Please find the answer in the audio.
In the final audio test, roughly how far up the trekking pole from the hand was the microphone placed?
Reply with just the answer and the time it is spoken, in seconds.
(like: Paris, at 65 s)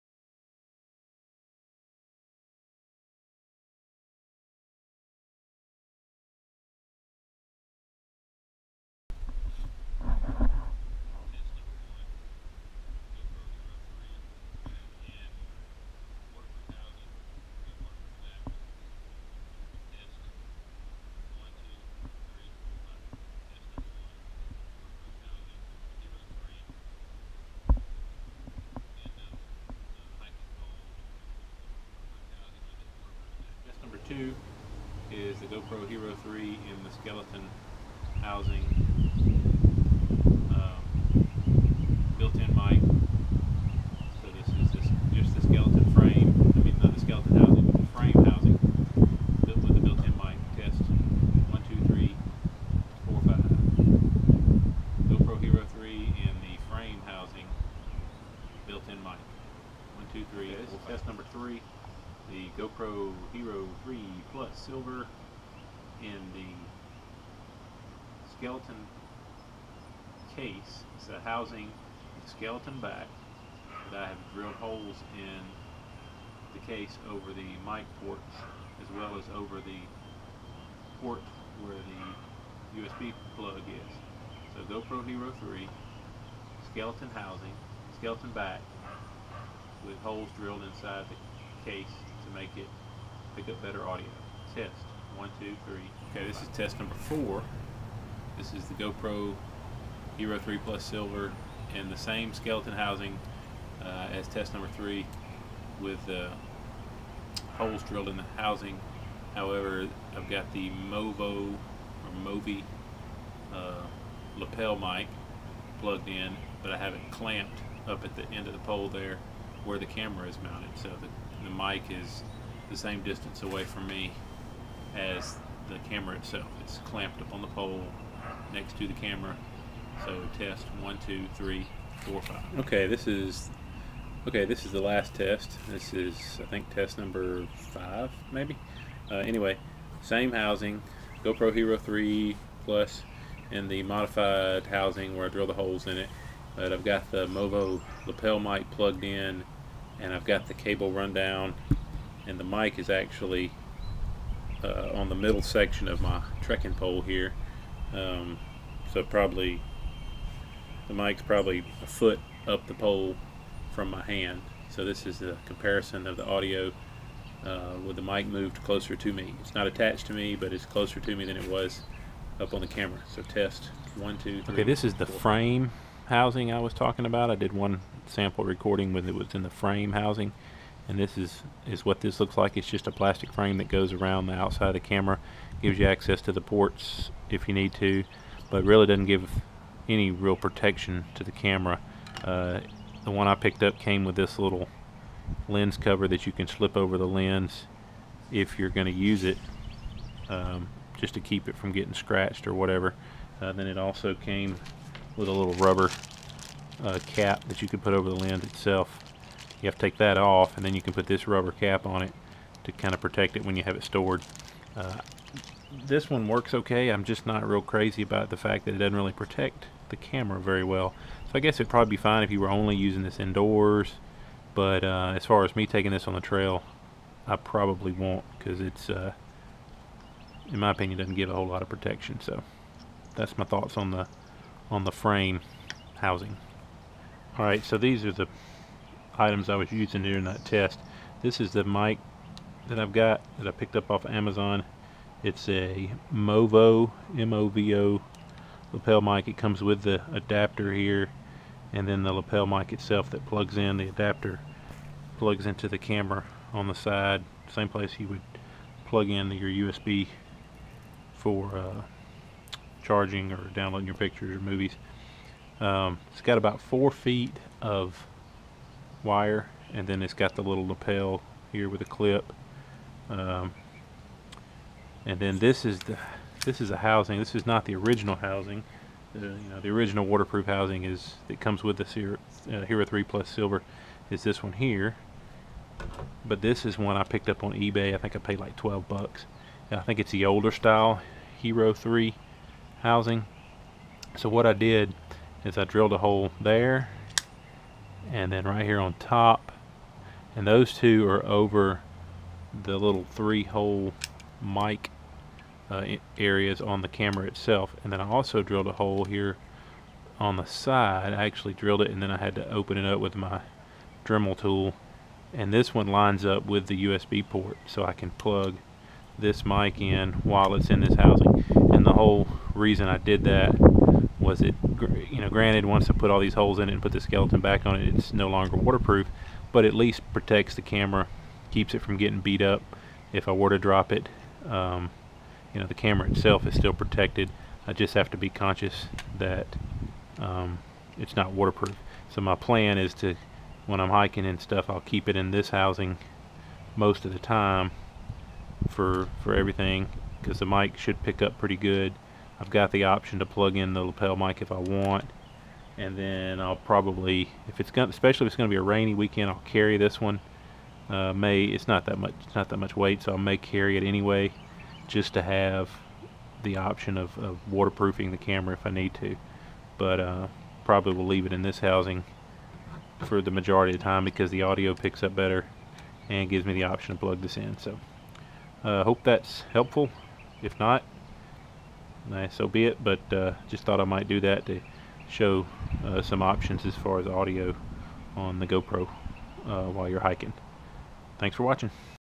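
a foot, at 161 s.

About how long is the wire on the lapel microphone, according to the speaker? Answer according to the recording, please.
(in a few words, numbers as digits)
4 feet.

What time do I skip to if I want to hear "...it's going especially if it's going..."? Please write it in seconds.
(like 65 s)
357 s.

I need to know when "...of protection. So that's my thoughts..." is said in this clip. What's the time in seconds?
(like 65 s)
231 s.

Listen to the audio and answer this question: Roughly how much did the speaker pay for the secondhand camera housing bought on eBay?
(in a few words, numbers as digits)
$12.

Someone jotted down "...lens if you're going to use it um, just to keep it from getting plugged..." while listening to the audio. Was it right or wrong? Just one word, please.
wrong.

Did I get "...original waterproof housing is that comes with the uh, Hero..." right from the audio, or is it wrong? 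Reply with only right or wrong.
right.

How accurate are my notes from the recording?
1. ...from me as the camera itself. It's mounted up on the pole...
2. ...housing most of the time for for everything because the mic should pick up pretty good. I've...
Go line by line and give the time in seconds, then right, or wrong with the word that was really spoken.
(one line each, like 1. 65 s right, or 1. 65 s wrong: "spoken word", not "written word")
1. 123 s wrong: "clamped", not "mounted"
2. 345 s right.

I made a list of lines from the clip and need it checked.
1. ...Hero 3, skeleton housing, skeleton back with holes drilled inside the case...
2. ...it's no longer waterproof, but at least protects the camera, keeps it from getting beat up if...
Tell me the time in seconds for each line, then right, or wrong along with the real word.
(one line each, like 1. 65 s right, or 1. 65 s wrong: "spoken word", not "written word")
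1. 85 s right
2. 327 s right.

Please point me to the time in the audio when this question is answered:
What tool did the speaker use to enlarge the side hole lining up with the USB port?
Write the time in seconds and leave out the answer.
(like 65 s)
314 s.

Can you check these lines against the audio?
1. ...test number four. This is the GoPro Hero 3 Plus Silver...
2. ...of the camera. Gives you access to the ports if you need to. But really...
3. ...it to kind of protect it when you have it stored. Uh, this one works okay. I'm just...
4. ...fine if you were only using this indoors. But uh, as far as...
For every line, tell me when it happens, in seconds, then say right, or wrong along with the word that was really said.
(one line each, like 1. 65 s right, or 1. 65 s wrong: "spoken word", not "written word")
1. 96 s right
2. 184 s right
3. 212 s right
4. 221 s right.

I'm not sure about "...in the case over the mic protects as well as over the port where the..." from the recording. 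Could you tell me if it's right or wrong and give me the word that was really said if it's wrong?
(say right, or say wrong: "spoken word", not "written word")
wrong: "ports", not "protects".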